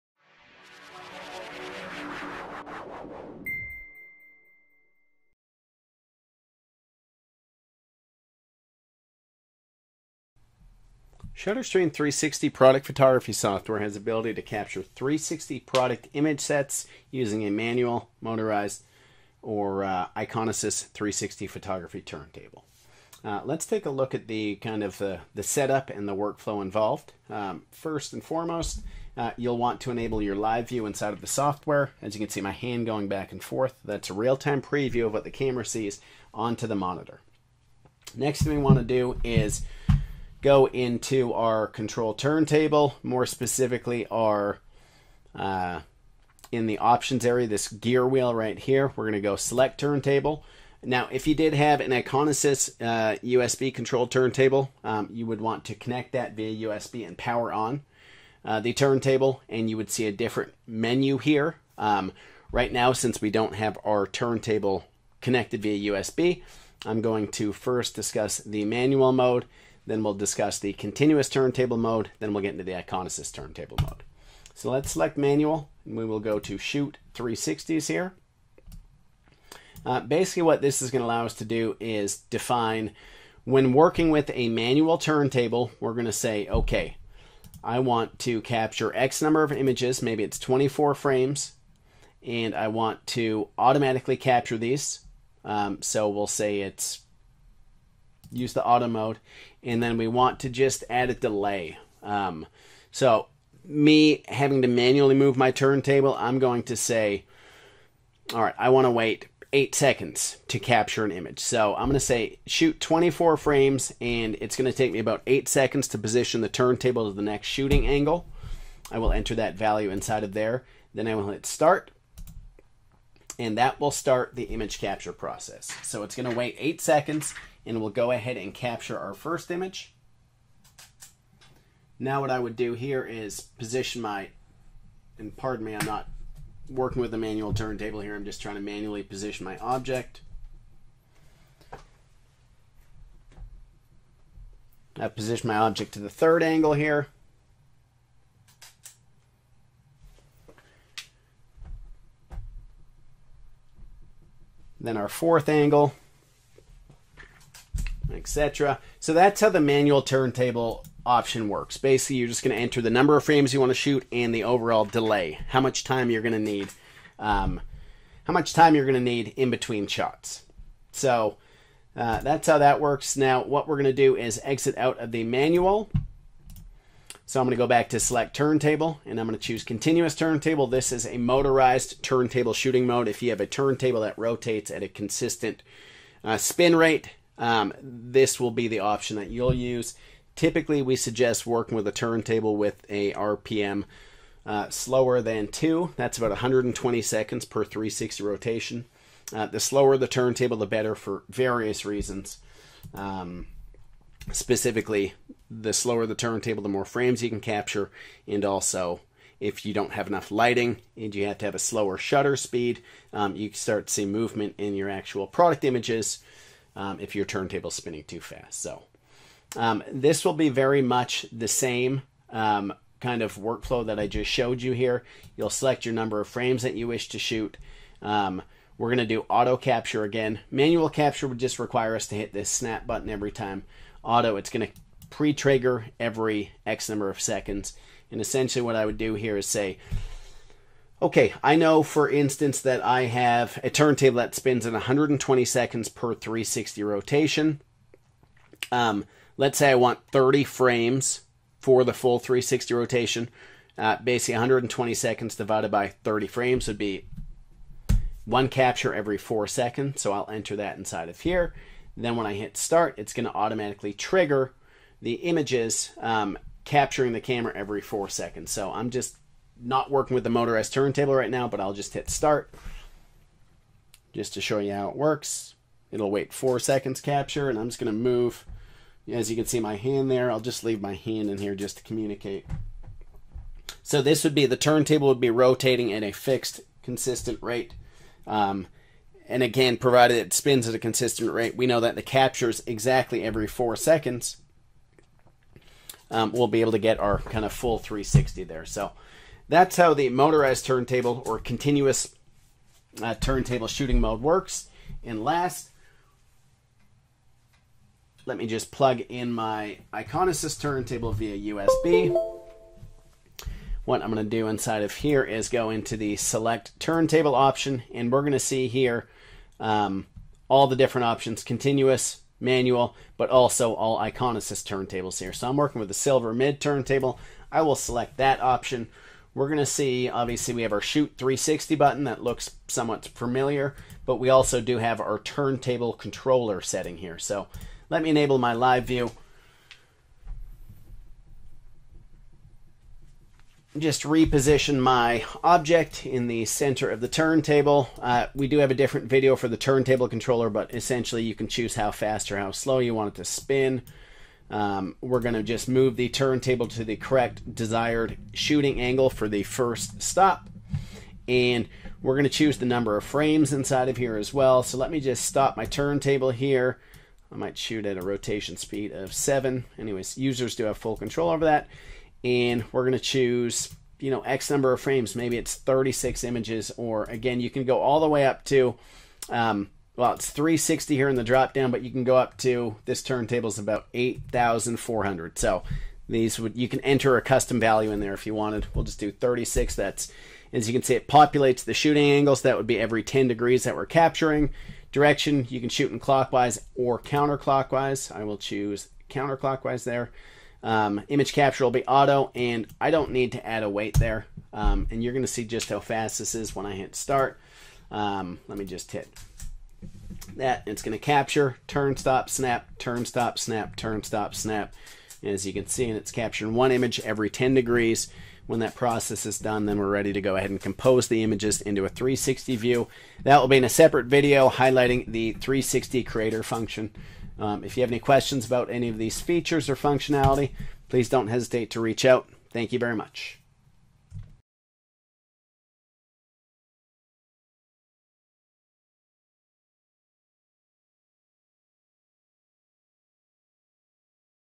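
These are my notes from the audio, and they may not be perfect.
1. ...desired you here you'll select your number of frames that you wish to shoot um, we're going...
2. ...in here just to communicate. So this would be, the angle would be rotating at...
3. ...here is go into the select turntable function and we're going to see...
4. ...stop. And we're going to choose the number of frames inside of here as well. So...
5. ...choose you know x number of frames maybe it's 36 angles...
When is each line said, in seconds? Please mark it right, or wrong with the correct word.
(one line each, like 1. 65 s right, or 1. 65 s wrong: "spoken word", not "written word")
1. 224 s wrong: "showed", not "desired"
2. 281 s wrong: "turntable", not "angle"
3. 314 s wrong: "option", not "function"
4. 360 s right
5. 372 s wrong: "images", not "angles".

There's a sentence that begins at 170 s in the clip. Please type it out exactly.
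So uh, that's how that works.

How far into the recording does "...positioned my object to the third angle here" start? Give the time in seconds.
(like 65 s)
145 s.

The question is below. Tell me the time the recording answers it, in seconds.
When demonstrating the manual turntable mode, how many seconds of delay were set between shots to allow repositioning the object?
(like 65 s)
109 s.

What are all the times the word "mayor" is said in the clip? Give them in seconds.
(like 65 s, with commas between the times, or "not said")
not said.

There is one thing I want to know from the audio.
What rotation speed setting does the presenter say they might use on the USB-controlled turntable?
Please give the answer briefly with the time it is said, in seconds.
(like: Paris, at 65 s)
7, at 368 s.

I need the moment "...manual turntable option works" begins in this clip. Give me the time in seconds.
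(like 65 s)
159 s.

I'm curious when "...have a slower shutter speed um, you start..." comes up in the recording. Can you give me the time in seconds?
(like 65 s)
211 s.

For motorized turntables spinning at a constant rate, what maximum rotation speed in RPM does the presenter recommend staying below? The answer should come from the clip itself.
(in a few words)
2.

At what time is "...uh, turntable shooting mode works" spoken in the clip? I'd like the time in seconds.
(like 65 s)
303 s.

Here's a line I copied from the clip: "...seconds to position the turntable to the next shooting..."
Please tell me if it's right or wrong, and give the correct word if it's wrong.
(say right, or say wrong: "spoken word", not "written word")
right.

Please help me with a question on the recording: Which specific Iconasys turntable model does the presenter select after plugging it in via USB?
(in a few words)
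Silver mid turntable.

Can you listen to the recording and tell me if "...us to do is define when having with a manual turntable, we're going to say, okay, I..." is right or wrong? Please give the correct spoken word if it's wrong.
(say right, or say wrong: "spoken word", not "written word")
wrong: "working", not "having".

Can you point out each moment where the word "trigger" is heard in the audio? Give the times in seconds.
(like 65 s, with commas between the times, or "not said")
235 s, 263 s.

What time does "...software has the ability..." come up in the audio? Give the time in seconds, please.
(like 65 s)
13 s.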